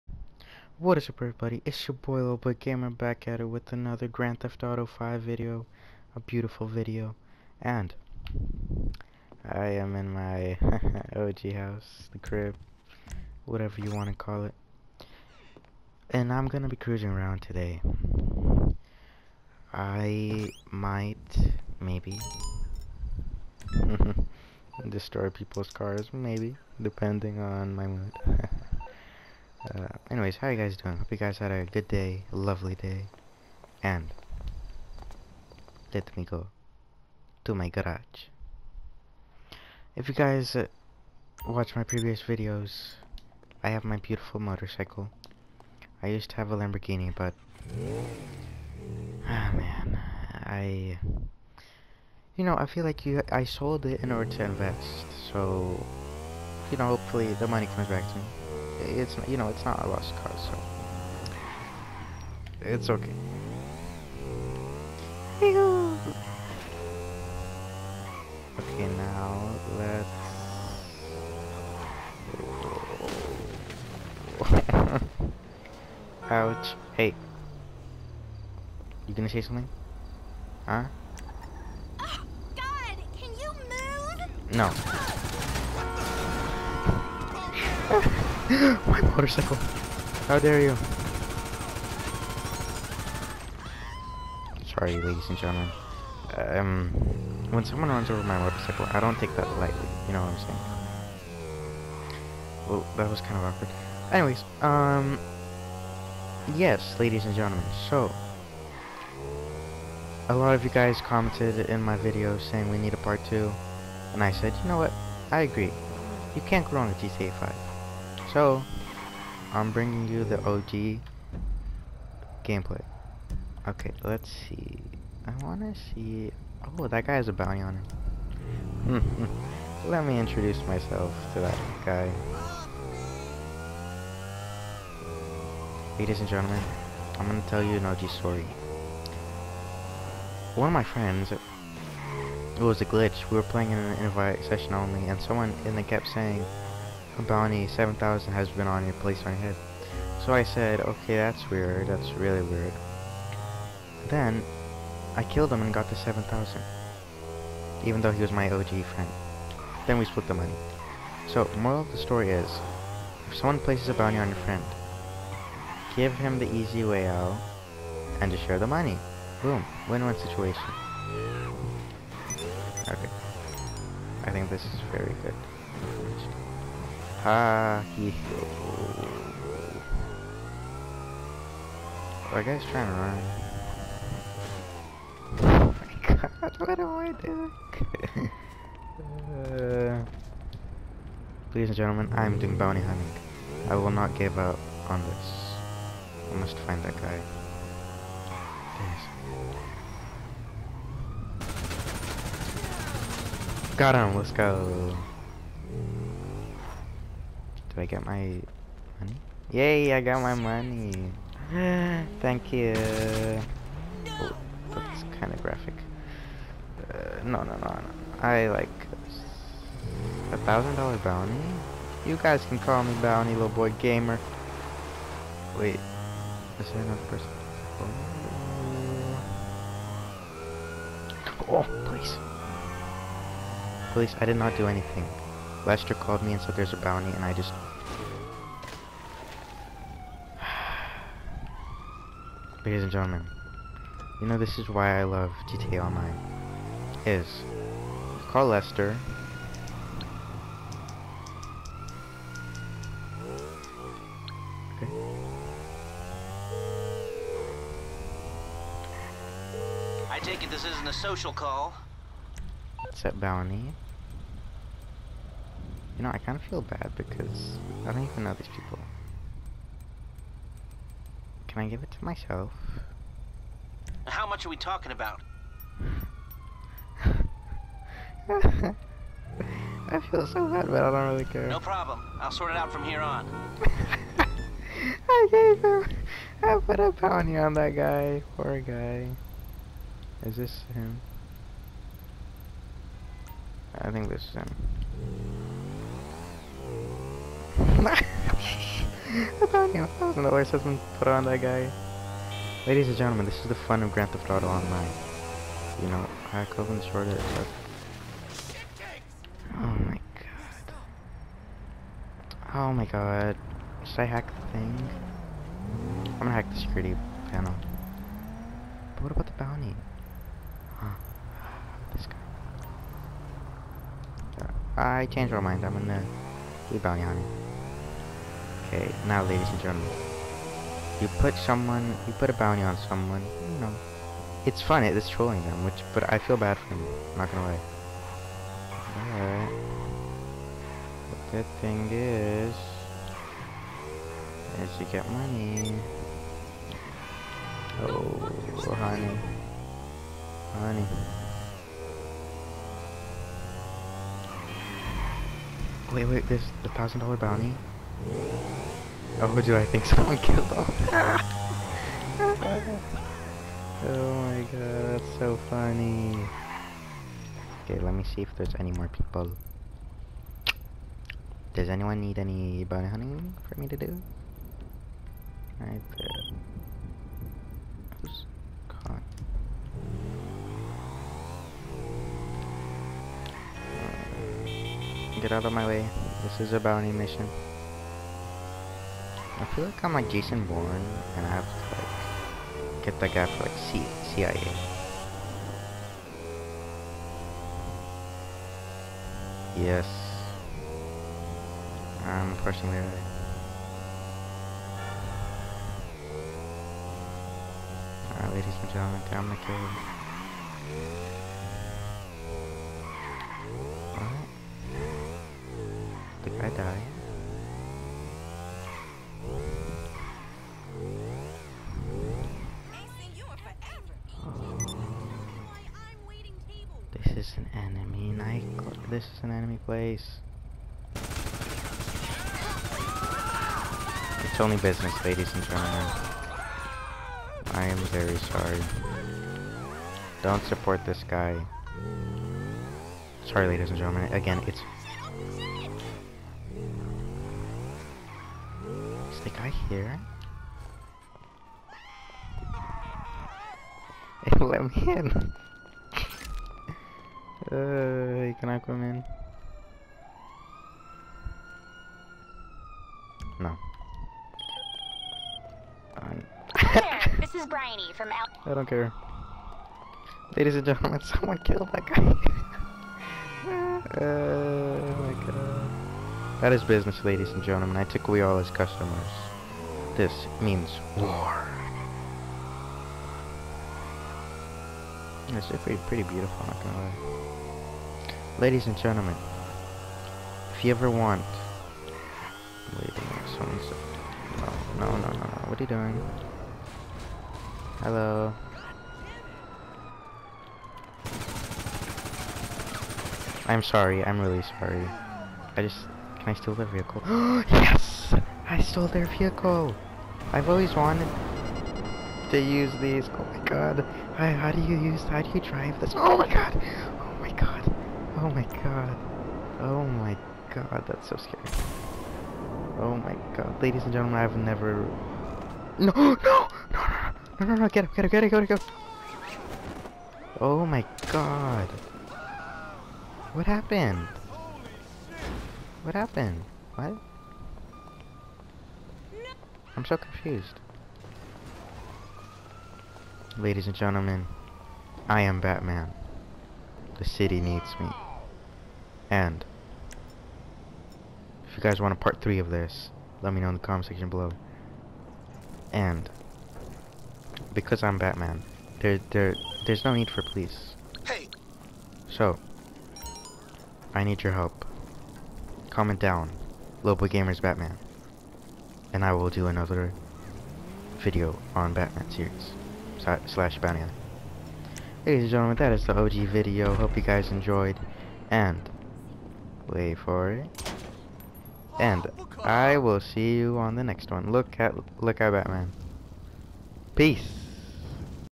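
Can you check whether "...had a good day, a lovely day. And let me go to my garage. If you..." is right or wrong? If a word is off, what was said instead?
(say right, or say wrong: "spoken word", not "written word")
right.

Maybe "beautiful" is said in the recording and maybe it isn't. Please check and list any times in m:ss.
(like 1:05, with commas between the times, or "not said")
0:06, 0:43, 8:06.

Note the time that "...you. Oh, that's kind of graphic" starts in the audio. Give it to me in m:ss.
3:32.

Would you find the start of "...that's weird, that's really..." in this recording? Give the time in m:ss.
2:31.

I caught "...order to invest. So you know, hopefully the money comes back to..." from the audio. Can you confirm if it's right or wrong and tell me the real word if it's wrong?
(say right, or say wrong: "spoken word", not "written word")
right.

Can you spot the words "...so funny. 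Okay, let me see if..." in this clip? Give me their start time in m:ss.
6:05.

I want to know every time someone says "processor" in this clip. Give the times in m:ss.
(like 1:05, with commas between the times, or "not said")
not said.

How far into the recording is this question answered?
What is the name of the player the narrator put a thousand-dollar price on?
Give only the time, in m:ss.
4:59.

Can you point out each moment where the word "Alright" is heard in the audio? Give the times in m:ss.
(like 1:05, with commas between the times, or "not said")
5:39, 6:15, 6:48.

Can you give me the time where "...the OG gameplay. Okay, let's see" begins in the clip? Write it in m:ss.
2:00.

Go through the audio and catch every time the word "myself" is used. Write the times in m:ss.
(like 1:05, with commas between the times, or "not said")
2:10, 4:32.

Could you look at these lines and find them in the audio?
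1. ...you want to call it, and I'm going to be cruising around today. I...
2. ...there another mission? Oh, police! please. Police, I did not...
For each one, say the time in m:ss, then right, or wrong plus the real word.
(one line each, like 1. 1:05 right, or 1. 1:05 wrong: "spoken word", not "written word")
1. 0:13 right
2. 3:46 wrong: "person", not "mission".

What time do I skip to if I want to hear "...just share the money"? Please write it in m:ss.
2:48.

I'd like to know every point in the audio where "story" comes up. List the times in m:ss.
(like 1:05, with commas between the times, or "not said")
2:18, 2:41.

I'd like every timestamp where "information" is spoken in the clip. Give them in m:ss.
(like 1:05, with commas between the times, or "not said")
2:55.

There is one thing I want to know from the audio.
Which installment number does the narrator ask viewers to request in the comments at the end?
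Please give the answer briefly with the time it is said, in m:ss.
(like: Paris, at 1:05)
3, at 9:11.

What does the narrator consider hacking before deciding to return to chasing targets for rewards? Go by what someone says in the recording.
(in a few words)
the security panel.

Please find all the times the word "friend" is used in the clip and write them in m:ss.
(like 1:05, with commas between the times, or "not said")
2:20, 2:38, 2:44.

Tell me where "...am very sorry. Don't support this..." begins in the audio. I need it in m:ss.
7:17.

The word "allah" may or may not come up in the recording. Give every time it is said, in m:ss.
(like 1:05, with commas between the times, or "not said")
not said.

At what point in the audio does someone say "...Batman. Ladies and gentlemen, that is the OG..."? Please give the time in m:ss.
9:33.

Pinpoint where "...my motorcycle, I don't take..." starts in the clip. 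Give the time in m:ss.
1:38.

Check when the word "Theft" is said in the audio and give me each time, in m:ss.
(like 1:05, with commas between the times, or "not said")
0:04, 5:04.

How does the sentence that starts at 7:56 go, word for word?
That is business, ladies and gentlemen.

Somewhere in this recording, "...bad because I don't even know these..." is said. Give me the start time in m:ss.
4:26.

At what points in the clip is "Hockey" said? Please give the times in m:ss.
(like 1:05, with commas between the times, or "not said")
2:57.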